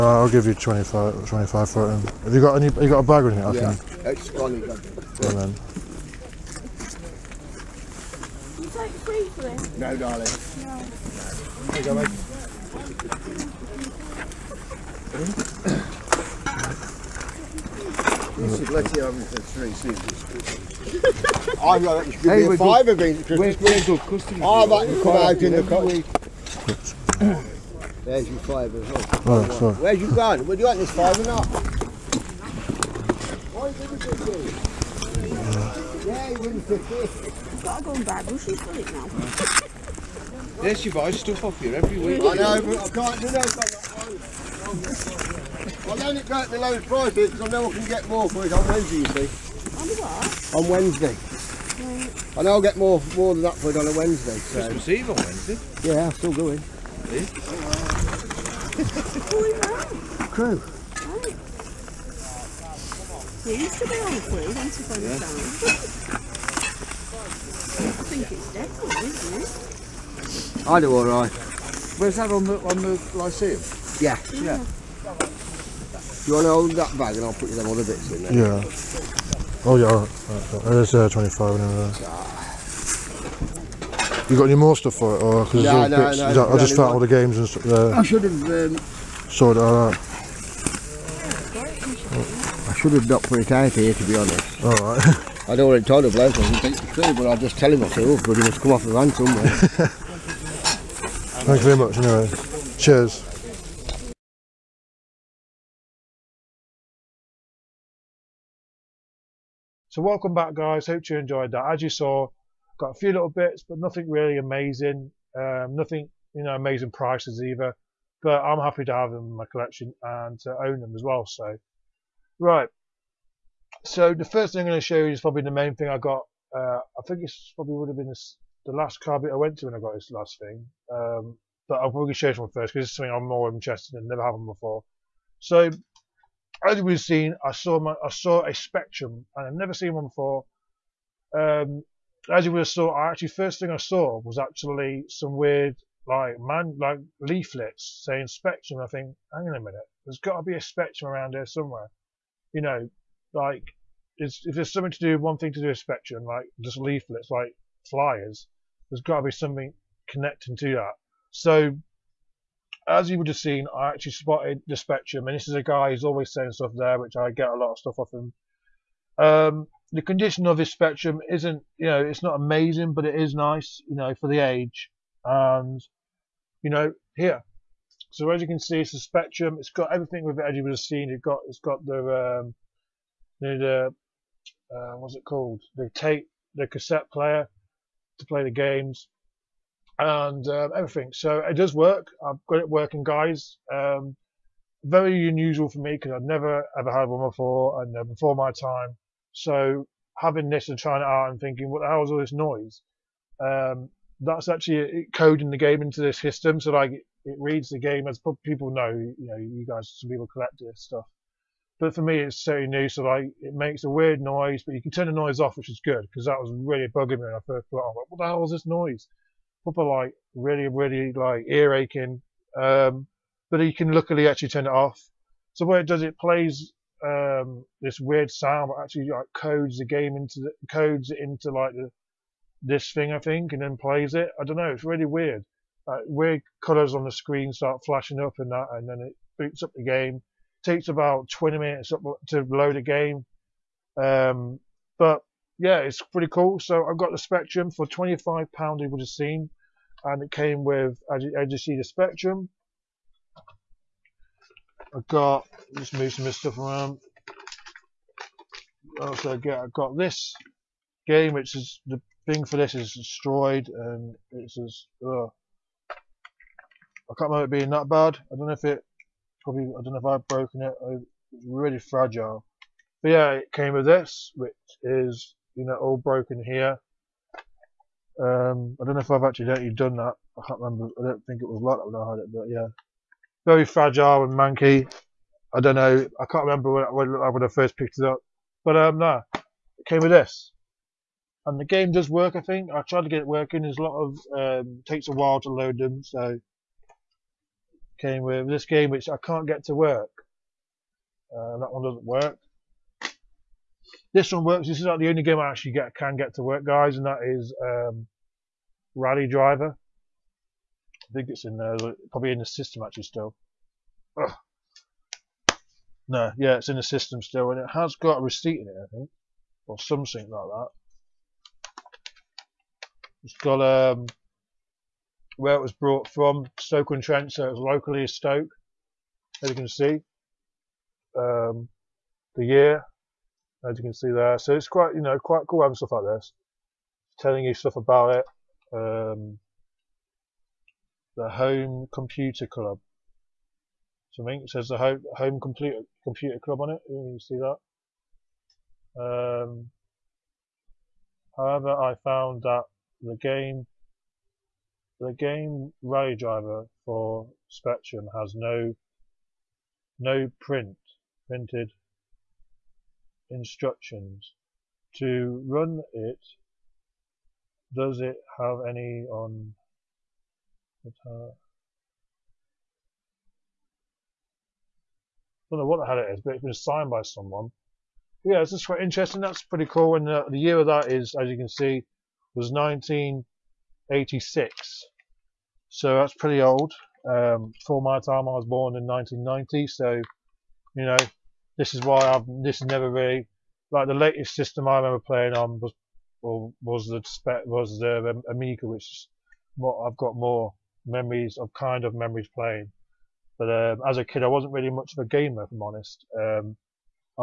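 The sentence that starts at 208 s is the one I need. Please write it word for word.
You know, you guys, some people collect this stuff.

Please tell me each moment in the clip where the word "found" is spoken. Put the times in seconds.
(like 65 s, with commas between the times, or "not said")
86 s, 352 s.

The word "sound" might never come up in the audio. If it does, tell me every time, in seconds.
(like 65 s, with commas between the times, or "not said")
228 s.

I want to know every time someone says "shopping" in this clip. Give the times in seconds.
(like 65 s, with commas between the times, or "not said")
not said.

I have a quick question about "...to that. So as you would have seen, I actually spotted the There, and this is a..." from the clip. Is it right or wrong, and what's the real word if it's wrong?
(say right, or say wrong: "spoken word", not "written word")
wrong: "Spectrum", not "There".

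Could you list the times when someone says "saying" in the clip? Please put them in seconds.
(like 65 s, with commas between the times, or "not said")
148 s, 166 s.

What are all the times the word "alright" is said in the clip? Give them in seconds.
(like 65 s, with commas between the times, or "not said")
70 s, 79 s, 94 s.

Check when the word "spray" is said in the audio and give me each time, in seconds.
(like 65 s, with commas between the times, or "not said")
not said.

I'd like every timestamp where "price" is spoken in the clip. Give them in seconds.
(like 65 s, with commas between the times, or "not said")
46 s, 116 s.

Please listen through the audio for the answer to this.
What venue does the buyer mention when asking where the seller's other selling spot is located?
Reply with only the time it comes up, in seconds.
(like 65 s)
72 s.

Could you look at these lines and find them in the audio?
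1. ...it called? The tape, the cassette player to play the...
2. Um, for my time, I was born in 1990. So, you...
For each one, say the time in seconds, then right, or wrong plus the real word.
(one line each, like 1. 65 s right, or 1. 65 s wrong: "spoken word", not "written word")
1. 185 s right
2. 387 s right.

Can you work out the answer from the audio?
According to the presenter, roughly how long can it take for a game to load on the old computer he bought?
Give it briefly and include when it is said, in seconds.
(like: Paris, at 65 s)
20 minutes, at 241 s.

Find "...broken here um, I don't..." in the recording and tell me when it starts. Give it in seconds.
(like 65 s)
275 s.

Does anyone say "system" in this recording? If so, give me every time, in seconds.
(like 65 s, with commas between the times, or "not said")
206 s, 312 s, 316 s, 394 s.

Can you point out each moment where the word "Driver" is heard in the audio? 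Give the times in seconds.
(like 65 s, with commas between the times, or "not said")
309 s, 356 s.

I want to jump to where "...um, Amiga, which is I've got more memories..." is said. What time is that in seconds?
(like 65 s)
398 s.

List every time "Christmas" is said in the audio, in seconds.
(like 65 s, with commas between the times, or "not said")
23 s, 54 s.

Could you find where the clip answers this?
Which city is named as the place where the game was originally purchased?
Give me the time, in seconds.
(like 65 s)
326 s.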